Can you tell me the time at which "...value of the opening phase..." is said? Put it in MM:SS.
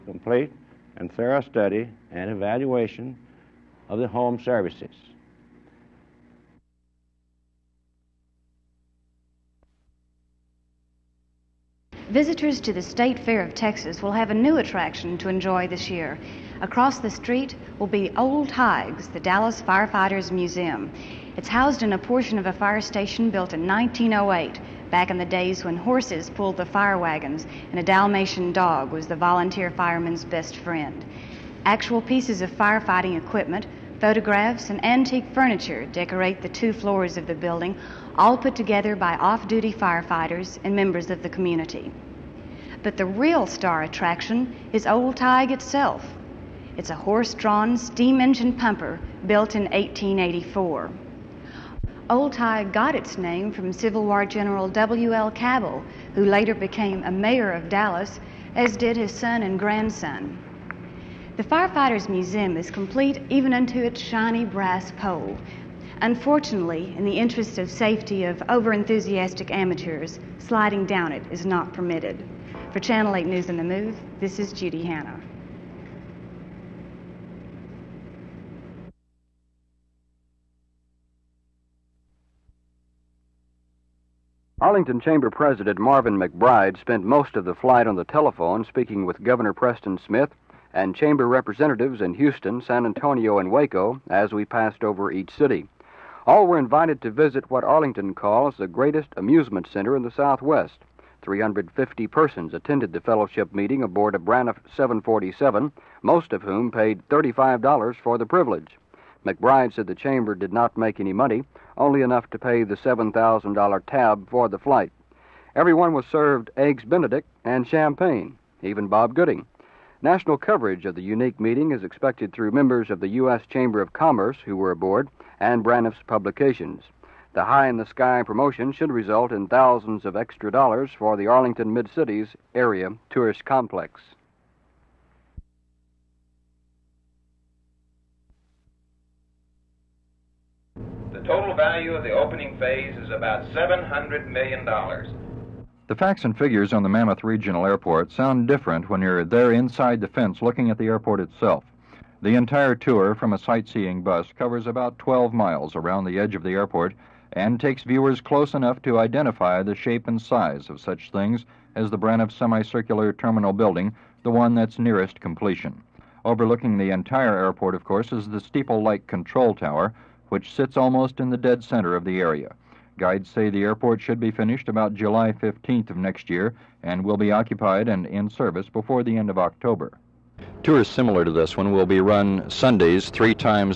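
02:21.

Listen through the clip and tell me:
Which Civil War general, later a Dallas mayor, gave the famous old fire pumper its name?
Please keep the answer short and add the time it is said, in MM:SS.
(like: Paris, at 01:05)
W.L. Cabell, at 00:54.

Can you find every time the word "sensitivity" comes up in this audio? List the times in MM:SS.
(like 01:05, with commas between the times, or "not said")
not said.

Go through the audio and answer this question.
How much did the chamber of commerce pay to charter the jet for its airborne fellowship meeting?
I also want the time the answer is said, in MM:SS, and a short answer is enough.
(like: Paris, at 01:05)
$7,000, at 01:52.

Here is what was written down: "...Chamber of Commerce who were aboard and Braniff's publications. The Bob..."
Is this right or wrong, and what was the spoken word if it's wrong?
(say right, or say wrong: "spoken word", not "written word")
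wrong: "High", not "Bob".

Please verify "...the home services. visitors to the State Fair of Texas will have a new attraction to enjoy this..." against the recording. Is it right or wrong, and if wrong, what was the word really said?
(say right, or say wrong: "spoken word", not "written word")
right.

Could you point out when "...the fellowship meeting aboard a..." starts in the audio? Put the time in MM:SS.
01:42.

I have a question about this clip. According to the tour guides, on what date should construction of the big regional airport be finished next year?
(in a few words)
July 15.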